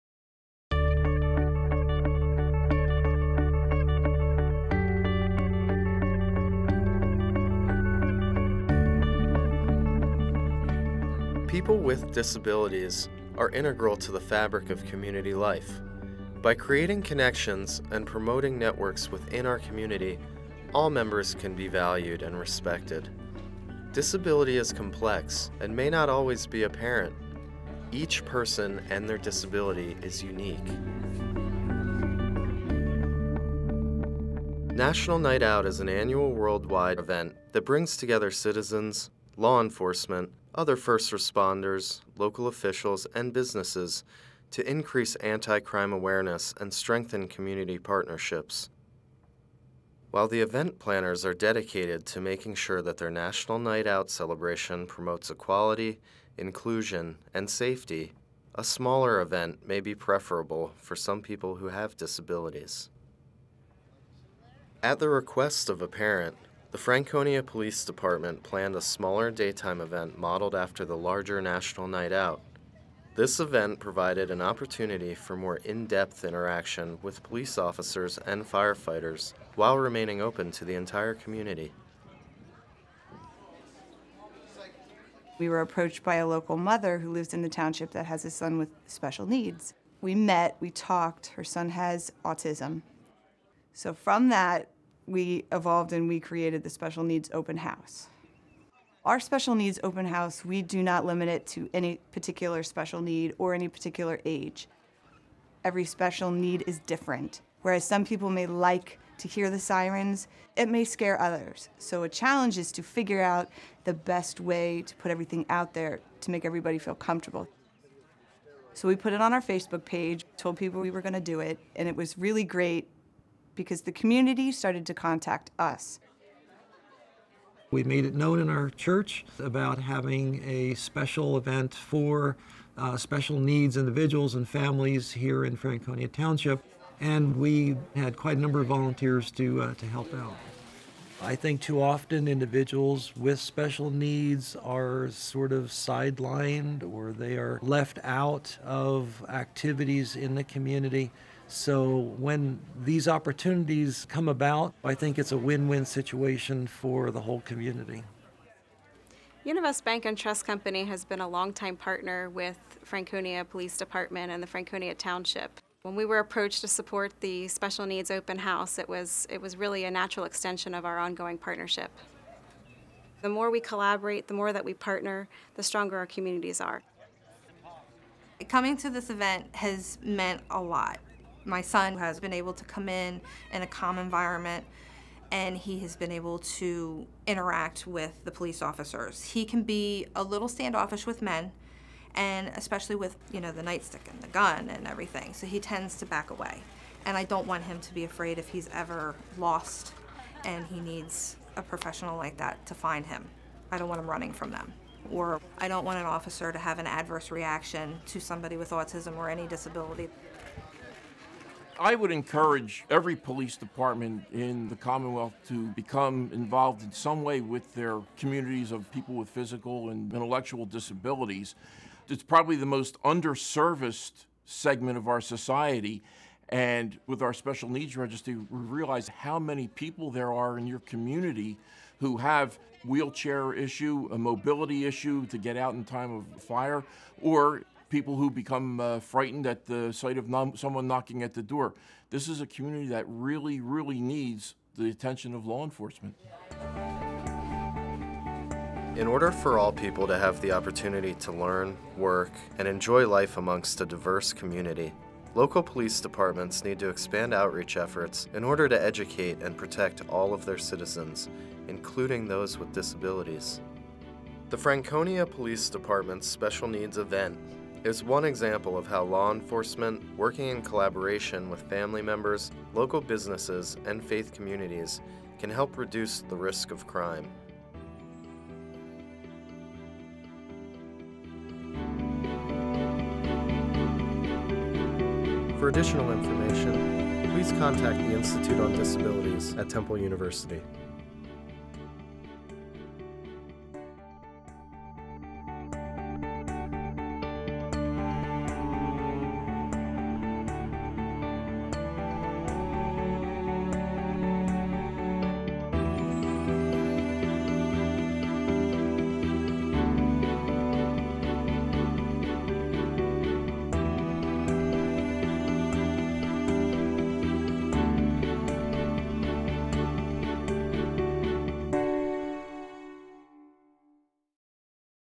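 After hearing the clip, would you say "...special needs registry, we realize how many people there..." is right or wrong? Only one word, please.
right.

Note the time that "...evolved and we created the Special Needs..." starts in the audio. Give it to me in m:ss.
1:35.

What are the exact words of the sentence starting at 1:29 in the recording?
We met, we talked, her son has autism.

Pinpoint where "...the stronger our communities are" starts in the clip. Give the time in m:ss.
2:55.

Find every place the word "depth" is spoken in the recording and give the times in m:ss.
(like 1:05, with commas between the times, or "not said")
1:15.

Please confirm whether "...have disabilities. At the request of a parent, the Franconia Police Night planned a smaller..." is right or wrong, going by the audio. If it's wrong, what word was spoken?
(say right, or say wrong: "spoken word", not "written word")
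wrong: "Department", not "Night".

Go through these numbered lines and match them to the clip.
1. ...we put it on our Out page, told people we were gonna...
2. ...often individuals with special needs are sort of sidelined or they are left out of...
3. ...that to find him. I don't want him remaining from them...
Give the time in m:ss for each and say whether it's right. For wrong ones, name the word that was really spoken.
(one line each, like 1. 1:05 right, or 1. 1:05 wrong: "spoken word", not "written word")
1. 1:58 wrong: "Facebook", not "Out"
2. 2:21 right
3. 3:22 wrong: "running", not "remaining".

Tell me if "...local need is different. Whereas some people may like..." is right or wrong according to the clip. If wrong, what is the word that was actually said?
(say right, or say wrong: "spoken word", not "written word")
wrong: "special", not "local".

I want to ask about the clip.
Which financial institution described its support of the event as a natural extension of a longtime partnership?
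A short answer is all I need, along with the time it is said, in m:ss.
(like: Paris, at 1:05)
Univest Bank and Trust Company, at 2:39.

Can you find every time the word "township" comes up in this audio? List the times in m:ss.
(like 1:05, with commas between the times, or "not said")
1:27, 2:16, 2:44.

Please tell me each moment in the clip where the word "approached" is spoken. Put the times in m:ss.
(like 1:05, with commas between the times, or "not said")
1:25, 2:46.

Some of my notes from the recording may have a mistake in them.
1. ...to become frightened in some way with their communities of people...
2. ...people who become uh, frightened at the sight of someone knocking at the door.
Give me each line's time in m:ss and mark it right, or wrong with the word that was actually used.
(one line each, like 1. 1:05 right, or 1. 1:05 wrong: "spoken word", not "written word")
1. 3:35 wrong: "involved", not "frightened"
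2. 3:57 right.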